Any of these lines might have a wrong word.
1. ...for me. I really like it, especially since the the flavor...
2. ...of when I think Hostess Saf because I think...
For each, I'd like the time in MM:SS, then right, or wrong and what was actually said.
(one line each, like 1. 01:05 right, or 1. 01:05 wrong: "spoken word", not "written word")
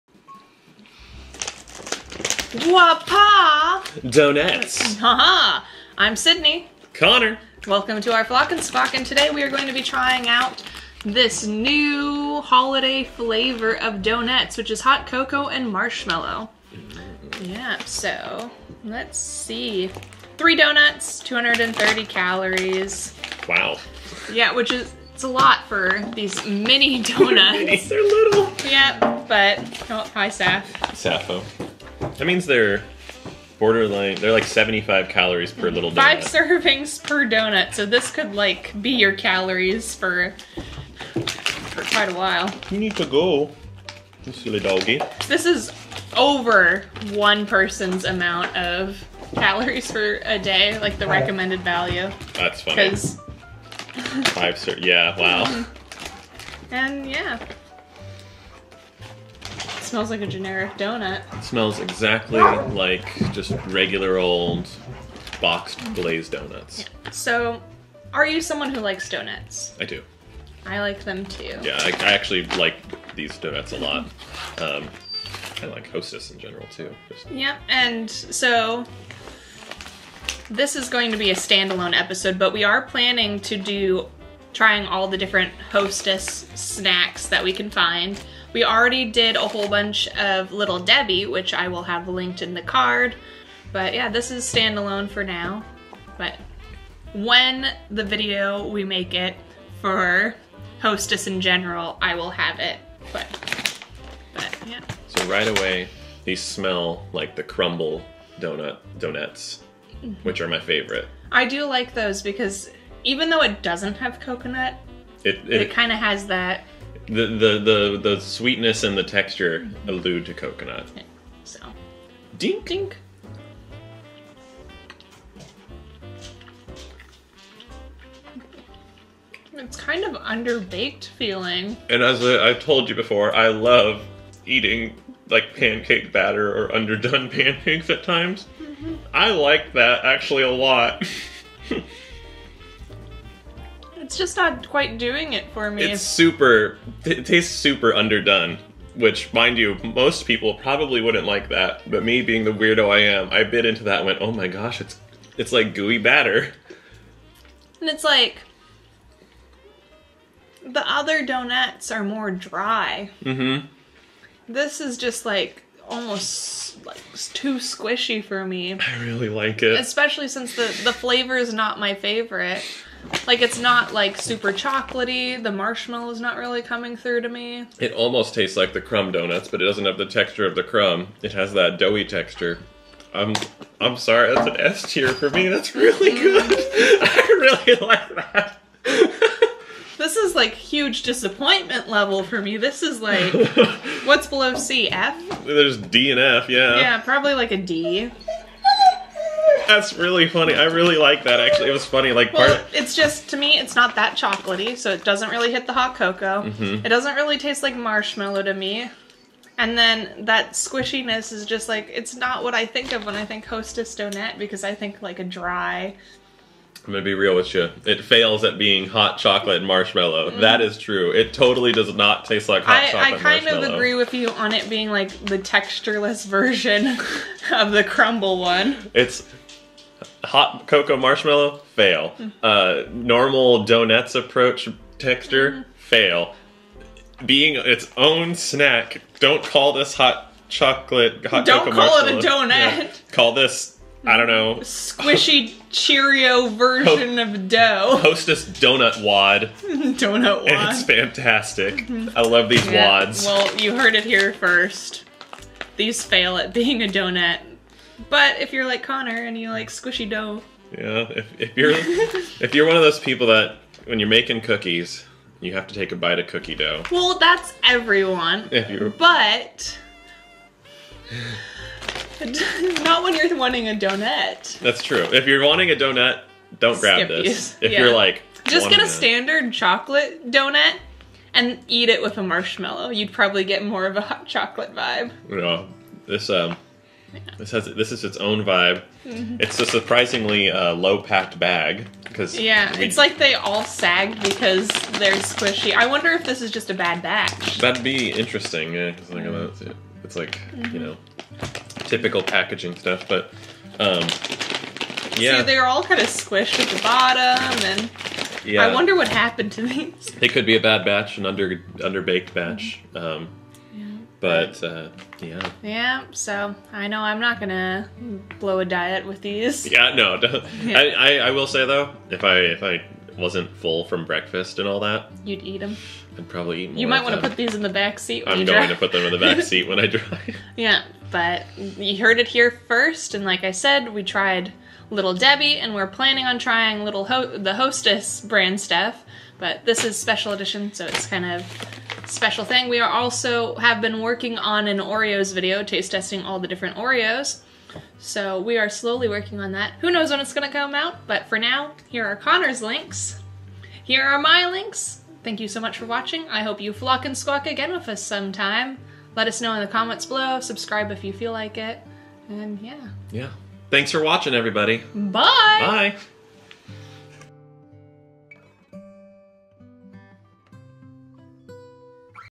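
1. 02:48 right
2. 03:32 wrong: "Donut", not "Saf".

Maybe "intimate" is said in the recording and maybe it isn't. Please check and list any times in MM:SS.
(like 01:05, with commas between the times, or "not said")
not said.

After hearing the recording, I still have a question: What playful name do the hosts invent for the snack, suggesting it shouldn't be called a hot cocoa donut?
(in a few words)
Hostess donut wad.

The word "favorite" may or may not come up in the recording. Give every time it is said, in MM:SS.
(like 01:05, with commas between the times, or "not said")
01:50, 02:51.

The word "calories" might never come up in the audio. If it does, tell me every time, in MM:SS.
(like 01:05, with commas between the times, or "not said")
00:22, 00:35, 00:39, 00:49.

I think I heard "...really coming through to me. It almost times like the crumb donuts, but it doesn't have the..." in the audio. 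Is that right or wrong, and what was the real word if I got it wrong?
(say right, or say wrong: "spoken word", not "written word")
wrong: "tastes", not "times".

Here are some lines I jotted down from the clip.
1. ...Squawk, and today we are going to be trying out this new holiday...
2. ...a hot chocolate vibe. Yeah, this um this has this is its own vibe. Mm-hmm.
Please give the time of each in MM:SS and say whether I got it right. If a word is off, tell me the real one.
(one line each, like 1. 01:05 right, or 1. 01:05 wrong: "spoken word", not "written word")
1. 00:08 right
2. 04:43 right.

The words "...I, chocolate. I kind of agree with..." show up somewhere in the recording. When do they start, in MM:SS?
03:42.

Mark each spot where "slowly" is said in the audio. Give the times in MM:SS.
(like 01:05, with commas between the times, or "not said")
05:48.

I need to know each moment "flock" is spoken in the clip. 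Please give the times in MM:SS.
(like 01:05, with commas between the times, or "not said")
00:08, 05:56.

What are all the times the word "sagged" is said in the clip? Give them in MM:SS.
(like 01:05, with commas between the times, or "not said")
04:53.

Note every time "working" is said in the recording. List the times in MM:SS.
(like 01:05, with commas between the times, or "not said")
05:44, 05:49.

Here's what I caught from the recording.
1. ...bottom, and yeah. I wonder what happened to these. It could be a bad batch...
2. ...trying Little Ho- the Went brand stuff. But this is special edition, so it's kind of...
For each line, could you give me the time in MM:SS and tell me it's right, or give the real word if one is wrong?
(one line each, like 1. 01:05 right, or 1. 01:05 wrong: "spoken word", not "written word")
1. 05:06 right
2. 05:36 wrong: "Hostess", not "Went".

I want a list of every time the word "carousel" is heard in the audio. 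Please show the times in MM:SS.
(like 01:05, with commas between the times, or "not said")
not said.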